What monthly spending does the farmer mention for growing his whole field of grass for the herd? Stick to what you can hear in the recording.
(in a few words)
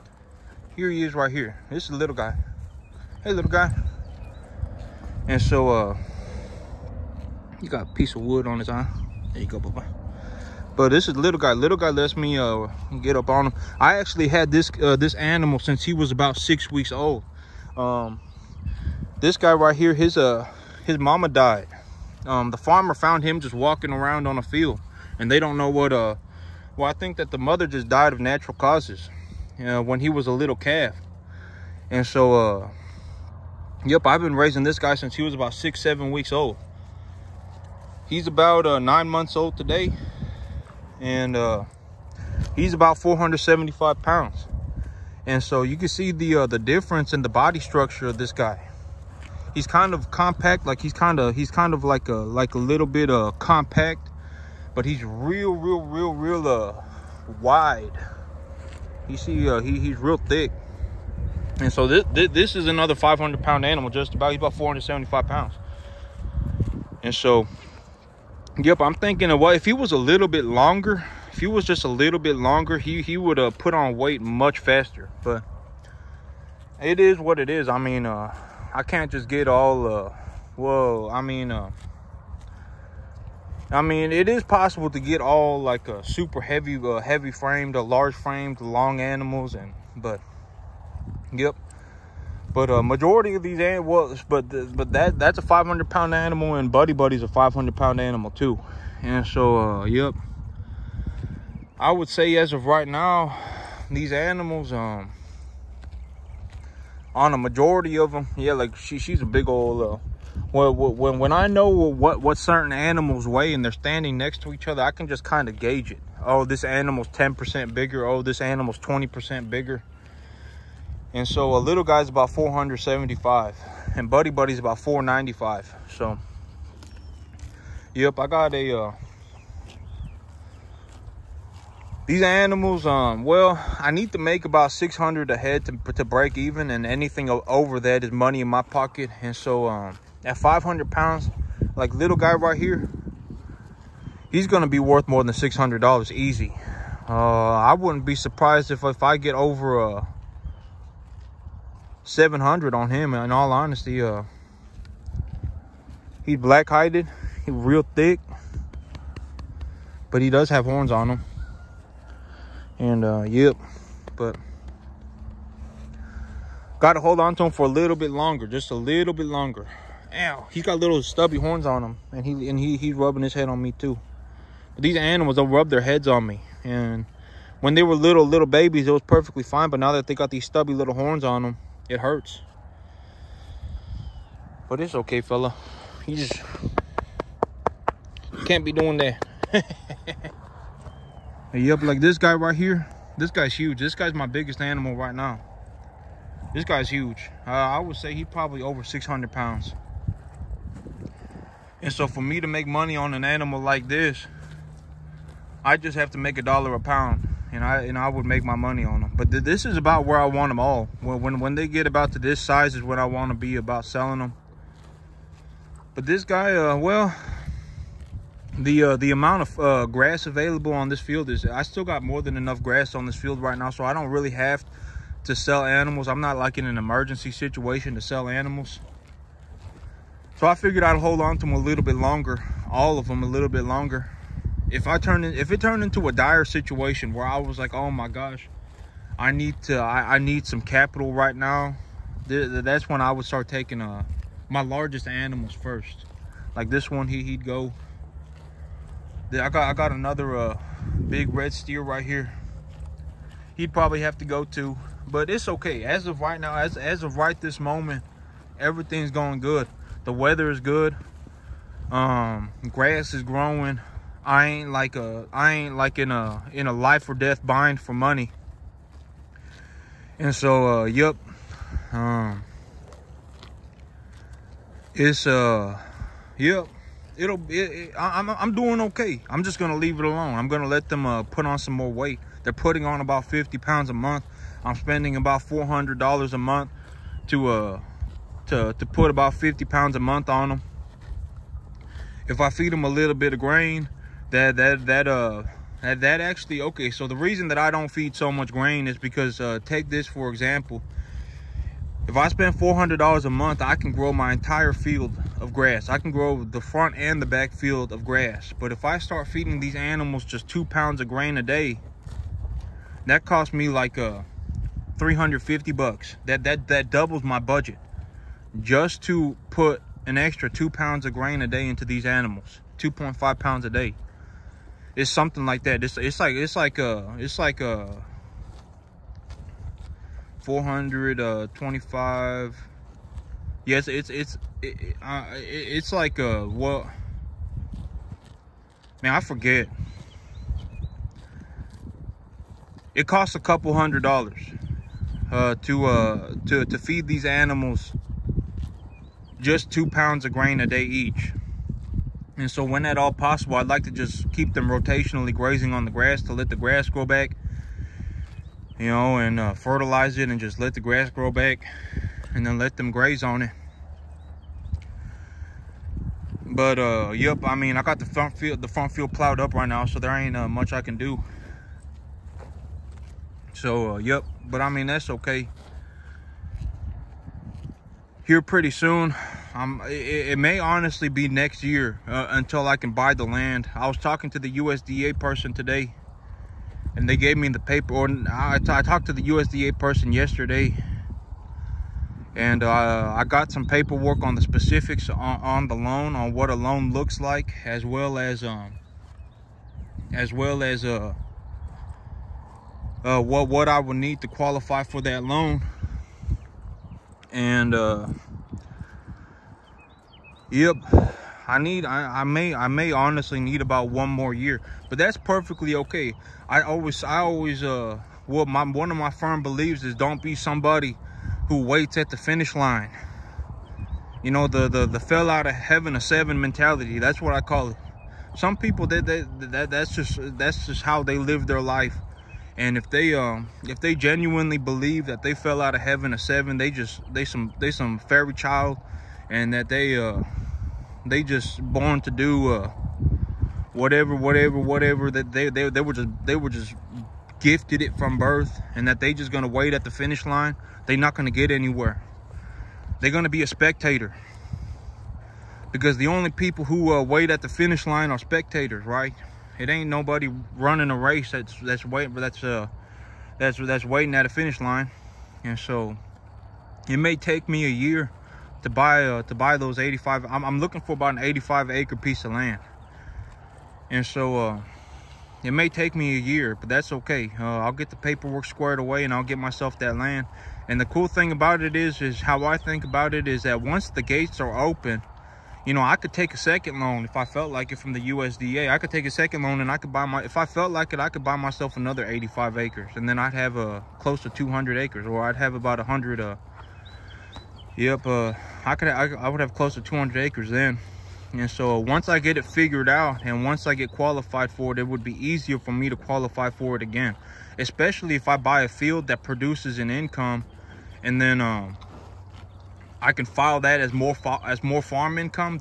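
400 dollars.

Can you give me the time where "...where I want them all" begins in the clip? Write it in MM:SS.
03:30.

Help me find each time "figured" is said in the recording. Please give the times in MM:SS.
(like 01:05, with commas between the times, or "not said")
03:50, 08:22.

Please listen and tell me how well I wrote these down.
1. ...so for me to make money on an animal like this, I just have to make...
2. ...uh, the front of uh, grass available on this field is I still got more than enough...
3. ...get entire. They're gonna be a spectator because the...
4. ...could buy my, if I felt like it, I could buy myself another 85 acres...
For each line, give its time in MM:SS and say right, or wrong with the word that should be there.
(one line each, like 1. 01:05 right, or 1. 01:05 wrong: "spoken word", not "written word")
1. 03:21 right
2. 03:38 wrong: "amount", not "front"
3. 07:31 wrong: "anywhere", not "entire"
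4. 08:09 right.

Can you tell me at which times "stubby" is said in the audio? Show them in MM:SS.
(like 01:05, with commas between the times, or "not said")
02:51, 03:00.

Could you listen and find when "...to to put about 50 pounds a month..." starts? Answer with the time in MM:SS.
04:48.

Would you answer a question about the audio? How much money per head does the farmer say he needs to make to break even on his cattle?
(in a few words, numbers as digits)
600.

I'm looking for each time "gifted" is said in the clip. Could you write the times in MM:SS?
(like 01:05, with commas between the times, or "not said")
07:27.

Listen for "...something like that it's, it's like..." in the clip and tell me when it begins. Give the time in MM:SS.
05:25.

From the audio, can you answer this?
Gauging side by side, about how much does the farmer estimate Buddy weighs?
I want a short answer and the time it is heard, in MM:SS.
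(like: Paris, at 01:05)
495, at 02:04.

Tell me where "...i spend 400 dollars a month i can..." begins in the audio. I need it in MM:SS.
05:02.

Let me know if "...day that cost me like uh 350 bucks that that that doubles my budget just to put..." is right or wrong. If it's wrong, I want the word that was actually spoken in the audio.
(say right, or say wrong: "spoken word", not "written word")
right.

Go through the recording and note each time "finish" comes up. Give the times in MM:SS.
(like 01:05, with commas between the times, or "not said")
07:02, 07:29, 07:37, 07:44.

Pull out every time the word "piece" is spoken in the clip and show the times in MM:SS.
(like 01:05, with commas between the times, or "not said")
00:07, 07:51.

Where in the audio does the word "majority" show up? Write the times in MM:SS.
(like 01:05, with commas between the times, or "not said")
01:32, 01:47.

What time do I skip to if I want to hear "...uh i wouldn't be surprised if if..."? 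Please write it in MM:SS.
02:27.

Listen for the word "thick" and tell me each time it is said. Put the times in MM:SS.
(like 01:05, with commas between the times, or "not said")
01:00, 02:37.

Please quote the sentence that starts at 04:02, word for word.
Th that's when I would start taking uh, my largest animals first.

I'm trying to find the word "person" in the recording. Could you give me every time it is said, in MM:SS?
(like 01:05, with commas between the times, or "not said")
06:25, 06:29.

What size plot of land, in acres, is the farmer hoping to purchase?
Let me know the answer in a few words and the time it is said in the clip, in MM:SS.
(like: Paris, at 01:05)
85 acres, at 07:51.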